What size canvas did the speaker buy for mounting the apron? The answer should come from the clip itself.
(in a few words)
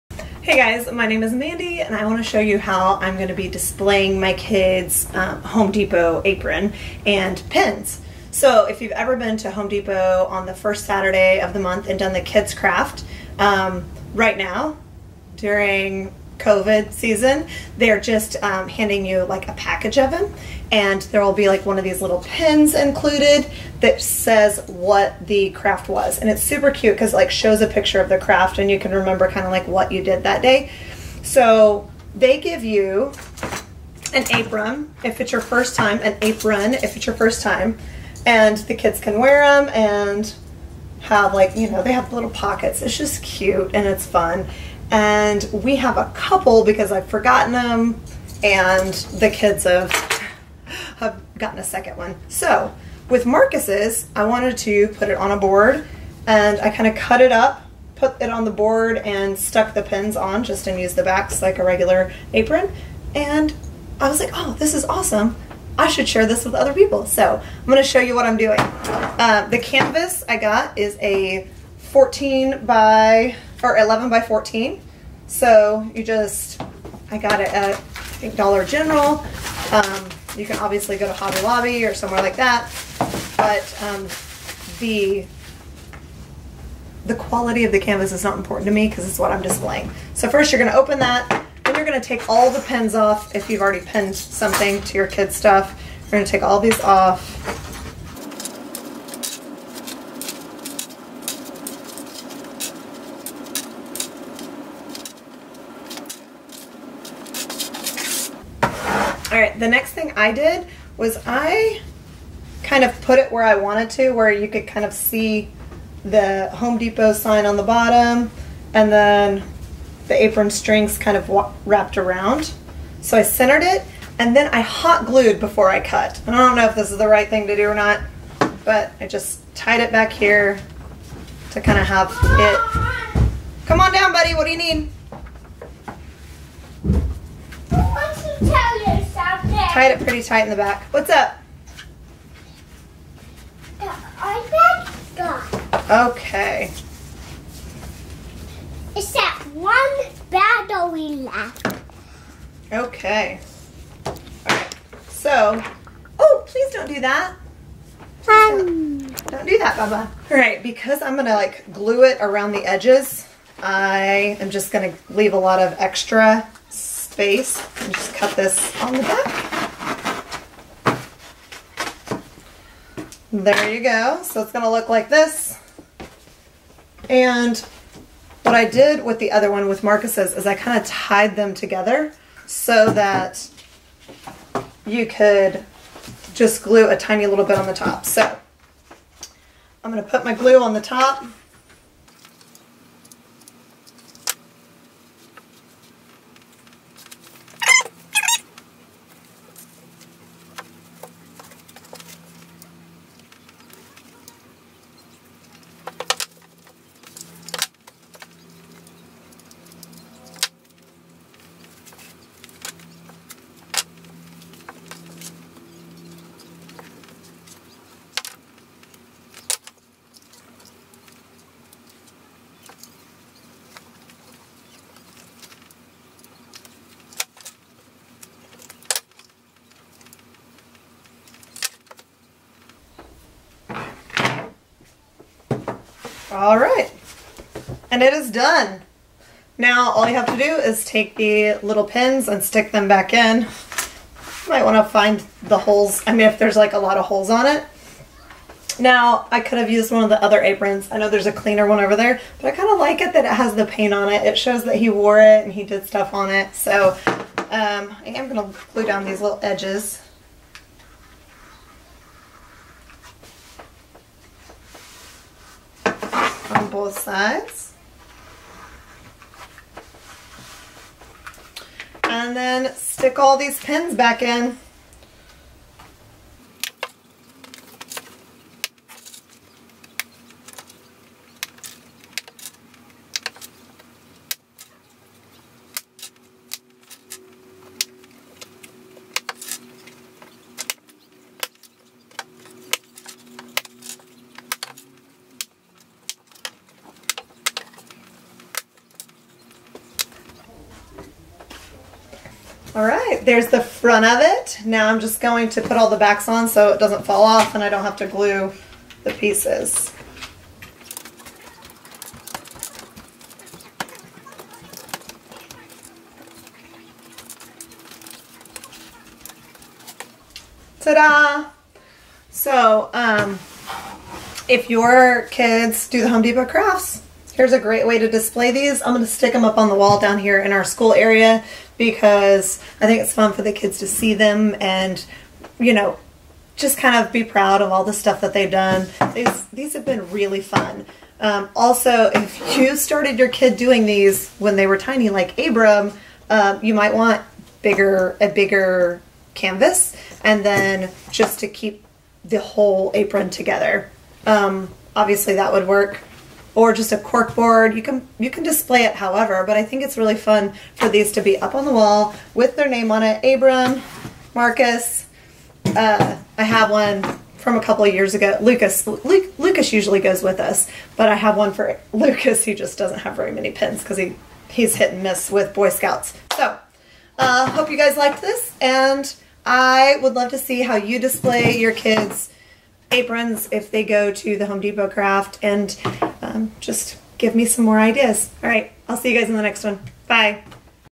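11 by 14.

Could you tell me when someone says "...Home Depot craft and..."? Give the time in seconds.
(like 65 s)
384 s.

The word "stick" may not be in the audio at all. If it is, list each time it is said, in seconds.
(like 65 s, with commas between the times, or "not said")
242 s, 272 s, 329 s.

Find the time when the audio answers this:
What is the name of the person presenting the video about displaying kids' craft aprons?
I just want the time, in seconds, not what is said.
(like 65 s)
1 s.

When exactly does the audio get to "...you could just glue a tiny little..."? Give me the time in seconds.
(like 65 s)
184 s.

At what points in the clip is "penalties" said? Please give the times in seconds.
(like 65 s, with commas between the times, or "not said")
not said.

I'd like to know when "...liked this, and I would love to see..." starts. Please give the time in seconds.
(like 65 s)
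377 s.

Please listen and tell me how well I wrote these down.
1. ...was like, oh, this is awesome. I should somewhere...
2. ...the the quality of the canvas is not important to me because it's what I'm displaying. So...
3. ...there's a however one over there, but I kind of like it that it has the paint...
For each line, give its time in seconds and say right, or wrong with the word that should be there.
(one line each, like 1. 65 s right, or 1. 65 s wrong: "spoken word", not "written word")
1. 64 s wrong: "share", not "somewhere"
2. 84 s right
3. 251 s wrong: "cleaner", not "however".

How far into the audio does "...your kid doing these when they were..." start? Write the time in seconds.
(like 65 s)
343 s.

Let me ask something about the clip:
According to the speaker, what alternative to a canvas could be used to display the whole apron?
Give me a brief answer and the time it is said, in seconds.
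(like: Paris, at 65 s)
cork board, at 356 s.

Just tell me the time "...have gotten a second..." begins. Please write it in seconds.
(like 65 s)
50 s.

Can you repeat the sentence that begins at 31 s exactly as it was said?
So they give you an apron if it's your first time, an apron if it's your first time.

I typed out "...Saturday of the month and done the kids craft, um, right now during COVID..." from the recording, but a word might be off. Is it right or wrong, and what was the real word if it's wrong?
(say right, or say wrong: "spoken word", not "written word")
right.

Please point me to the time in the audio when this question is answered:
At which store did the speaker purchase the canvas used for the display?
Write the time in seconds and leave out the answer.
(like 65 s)
78 s.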